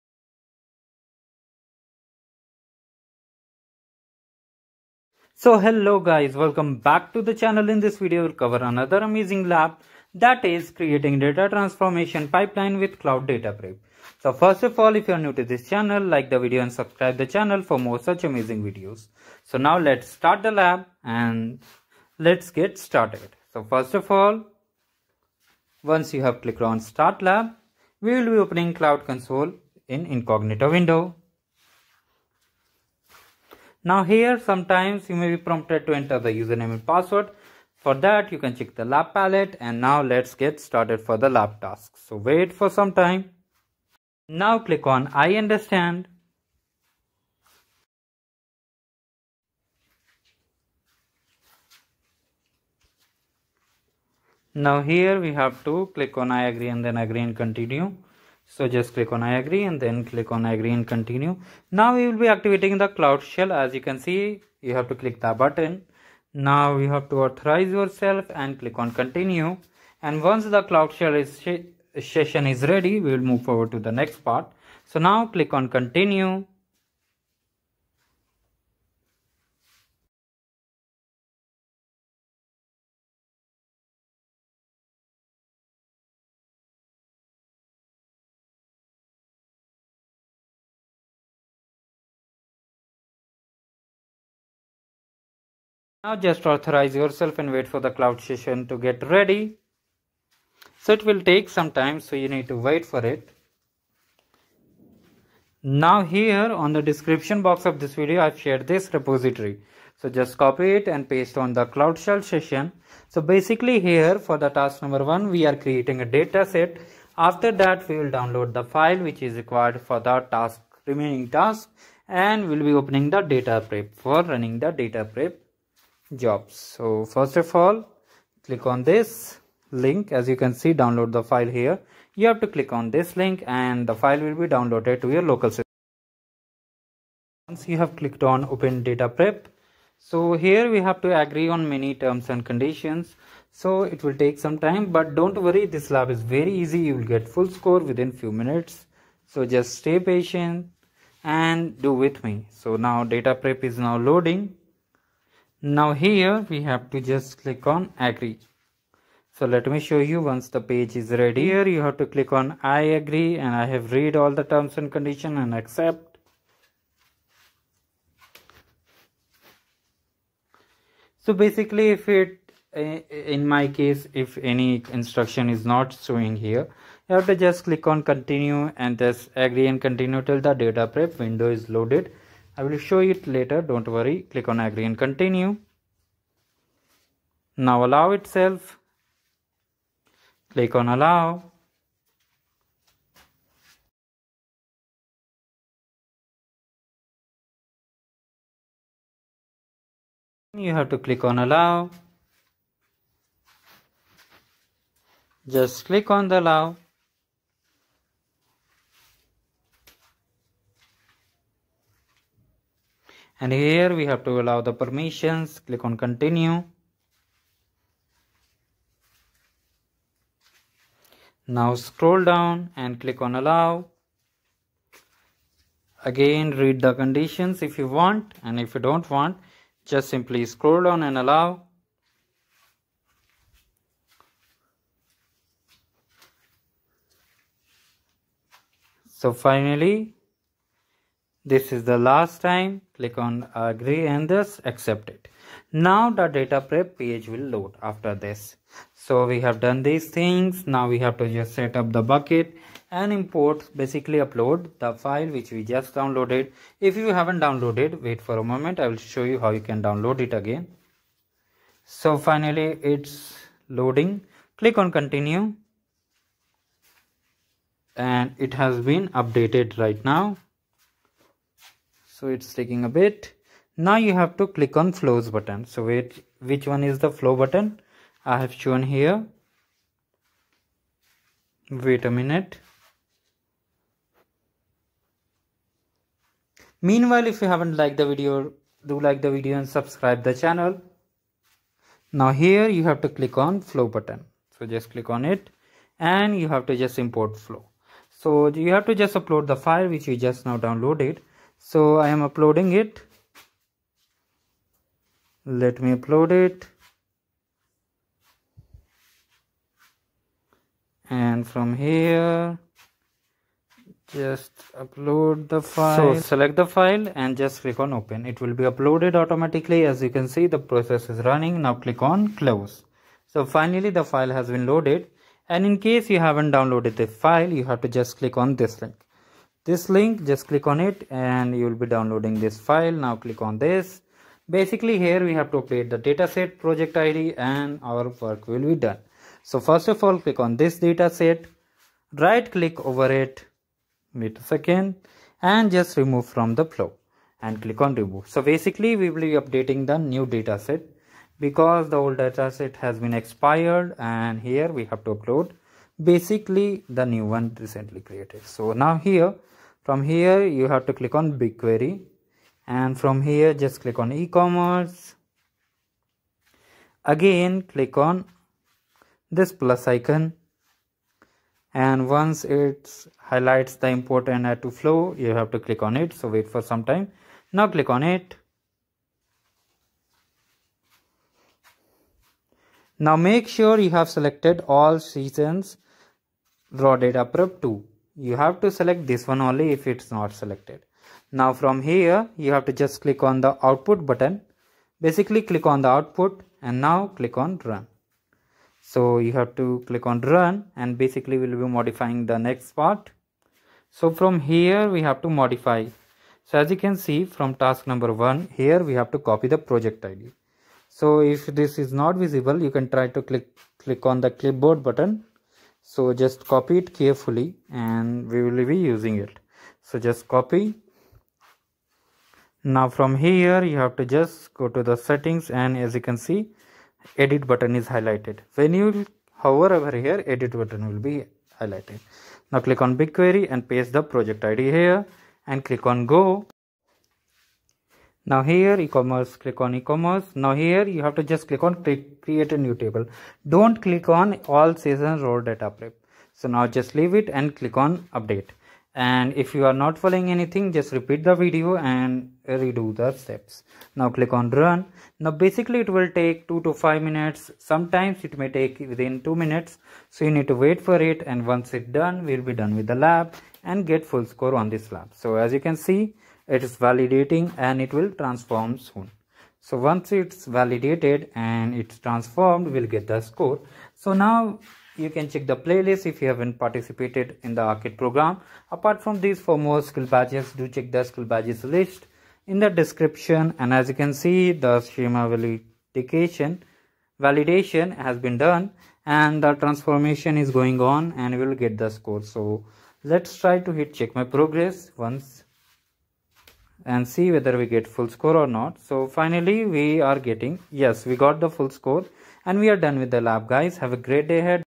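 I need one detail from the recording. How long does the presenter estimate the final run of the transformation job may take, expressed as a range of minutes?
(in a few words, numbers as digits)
2 to 5 minutes.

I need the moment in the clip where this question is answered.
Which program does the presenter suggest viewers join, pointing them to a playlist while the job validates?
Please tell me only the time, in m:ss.
7:57.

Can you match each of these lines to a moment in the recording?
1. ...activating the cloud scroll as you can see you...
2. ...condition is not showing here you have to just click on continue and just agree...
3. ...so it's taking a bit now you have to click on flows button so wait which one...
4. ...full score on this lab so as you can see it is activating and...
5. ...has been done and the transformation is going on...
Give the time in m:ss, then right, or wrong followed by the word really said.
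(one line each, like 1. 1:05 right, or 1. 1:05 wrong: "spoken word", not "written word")
1. 1:02 wrong: "shell", not "scroll"
2. 2:54 wrong: "instruction", not "condition"
3. 4:32 right
4. 7:44 wrong: "validating", not "activating"
5. 8:08 right.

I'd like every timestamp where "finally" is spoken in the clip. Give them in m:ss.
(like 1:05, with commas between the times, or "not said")
3:59, 4:22, 5:23, 8:19.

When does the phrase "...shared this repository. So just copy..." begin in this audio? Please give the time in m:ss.
1:48.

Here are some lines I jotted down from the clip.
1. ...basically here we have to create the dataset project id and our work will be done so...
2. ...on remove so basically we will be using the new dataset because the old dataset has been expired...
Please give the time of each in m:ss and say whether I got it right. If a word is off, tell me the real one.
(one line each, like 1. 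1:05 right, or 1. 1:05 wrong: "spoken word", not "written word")
1. 5:34 right
2. 5:47 wrong: "updating", not "using".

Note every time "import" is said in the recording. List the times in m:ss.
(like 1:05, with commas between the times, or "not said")
4:13, 4:57, 6:13.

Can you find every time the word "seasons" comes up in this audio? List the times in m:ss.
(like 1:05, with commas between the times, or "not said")
6:24, 7:24.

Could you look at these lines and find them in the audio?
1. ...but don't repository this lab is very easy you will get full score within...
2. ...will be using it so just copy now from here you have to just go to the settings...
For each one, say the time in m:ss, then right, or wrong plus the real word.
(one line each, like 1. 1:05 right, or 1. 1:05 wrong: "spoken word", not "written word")
1. 2:24 wrong: "worry", not "repository"
2. 6:58 right.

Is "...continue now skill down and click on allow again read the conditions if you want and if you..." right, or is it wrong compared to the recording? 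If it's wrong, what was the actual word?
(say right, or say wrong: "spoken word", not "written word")
wrong: "scroll", not "skill".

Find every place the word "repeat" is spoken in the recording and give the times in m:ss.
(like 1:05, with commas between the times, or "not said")
7:30.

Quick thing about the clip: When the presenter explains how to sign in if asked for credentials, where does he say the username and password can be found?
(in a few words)
lab palette.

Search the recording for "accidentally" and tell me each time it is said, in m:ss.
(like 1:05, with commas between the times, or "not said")
not said.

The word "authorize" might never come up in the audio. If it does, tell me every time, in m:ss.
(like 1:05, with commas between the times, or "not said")
1:07, 1:36.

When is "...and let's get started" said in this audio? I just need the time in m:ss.
0:21.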